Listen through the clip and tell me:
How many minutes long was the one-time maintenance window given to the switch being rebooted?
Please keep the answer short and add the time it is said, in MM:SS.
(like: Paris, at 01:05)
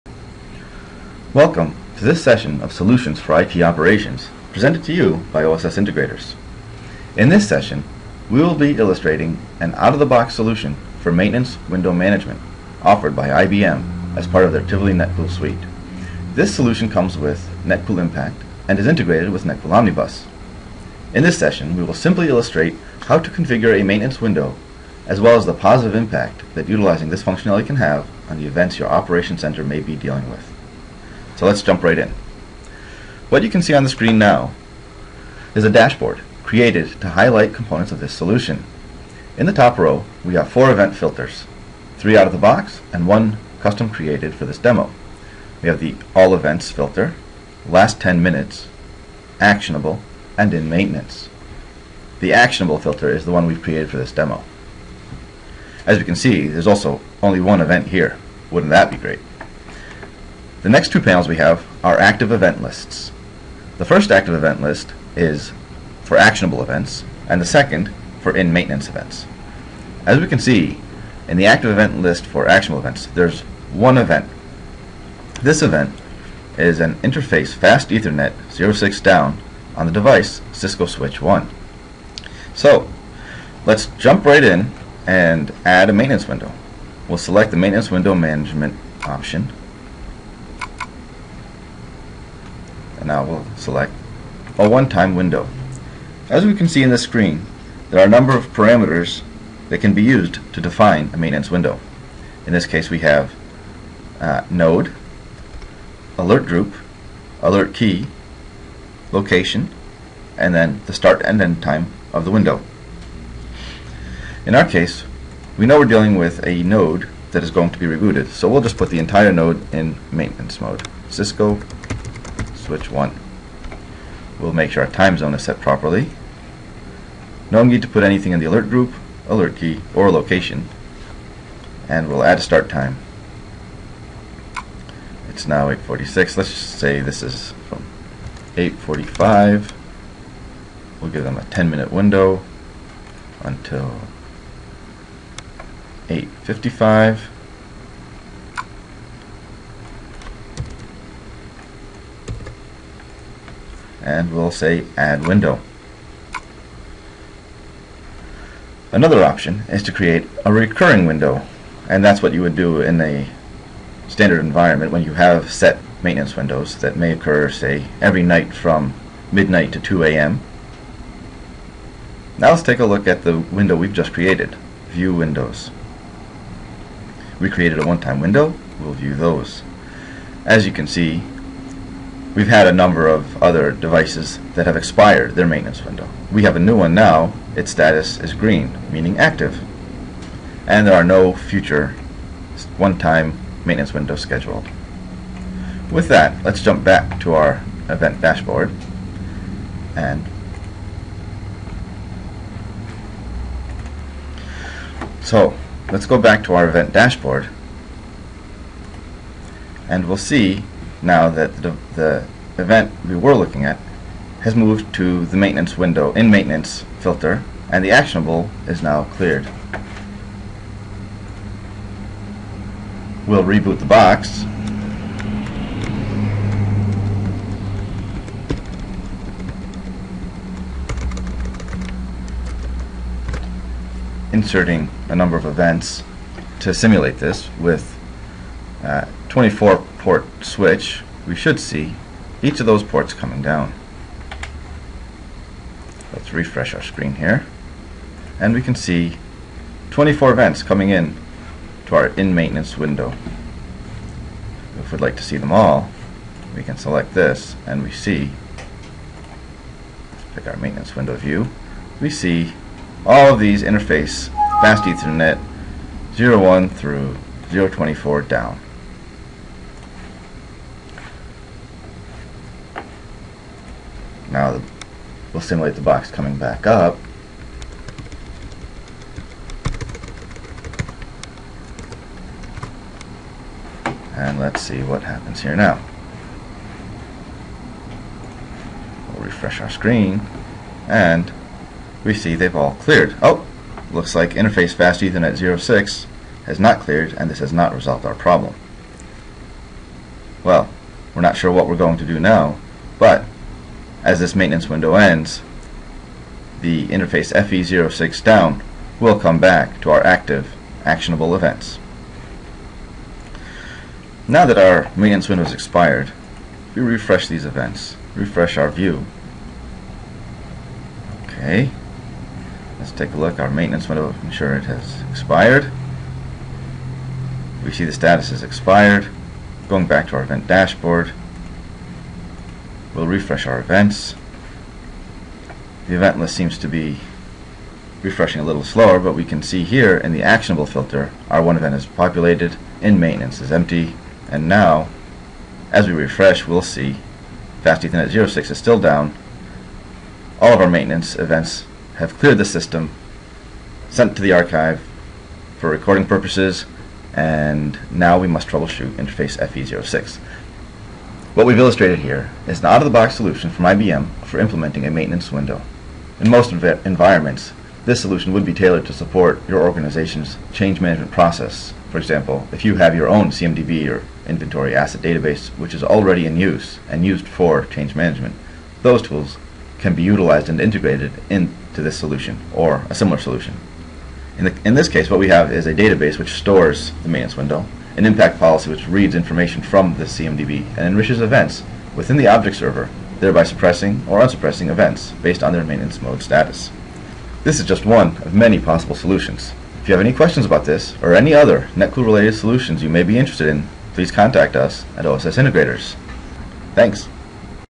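10, at 02:21.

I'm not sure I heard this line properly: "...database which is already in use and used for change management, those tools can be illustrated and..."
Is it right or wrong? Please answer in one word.
wrong.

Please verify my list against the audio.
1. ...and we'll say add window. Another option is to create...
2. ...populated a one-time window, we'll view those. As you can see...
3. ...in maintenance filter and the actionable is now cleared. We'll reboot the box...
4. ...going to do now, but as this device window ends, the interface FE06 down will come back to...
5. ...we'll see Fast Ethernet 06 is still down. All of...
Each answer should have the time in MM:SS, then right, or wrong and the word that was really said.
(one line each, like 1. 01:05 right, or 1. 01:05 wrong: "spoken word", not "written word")
1. 02:34 right
2. 02:57 wrong: "created", not "populated"
3. 03:36 right
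4. 05:01 wrong: "maintenance", not "device"
5. 05:46 right.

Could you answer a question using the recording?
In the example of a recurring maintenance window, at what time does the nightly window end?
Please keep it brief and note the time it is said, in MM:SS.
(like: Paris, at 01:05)
2 a.m., at 02:49.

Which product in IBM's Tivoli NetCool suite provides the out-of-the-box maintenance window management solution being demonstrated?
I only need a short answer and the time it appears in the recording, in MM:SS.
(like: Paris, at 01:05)
NetCool Impact, at 00:17.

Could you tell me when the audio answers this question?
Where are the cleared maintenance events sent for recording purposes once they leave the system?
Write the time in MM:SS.
05:54.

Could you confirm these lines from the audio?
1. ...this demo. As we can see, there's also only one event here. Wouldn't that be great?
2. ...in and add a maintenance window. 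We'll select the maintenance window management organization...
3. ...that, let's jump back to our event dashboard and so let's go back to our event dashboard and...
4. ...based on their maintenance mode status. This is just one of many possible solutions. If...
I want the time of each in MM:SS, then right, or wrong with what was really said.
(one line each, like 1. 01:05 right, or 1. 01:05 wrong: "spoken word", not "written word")
1. 00:53 right
2. 01:24 wrong: "option", not "organization"
3. 03:16 right
4. 06:35 right.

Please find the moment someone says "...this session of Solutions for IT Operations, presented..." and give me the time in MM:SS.
00:02.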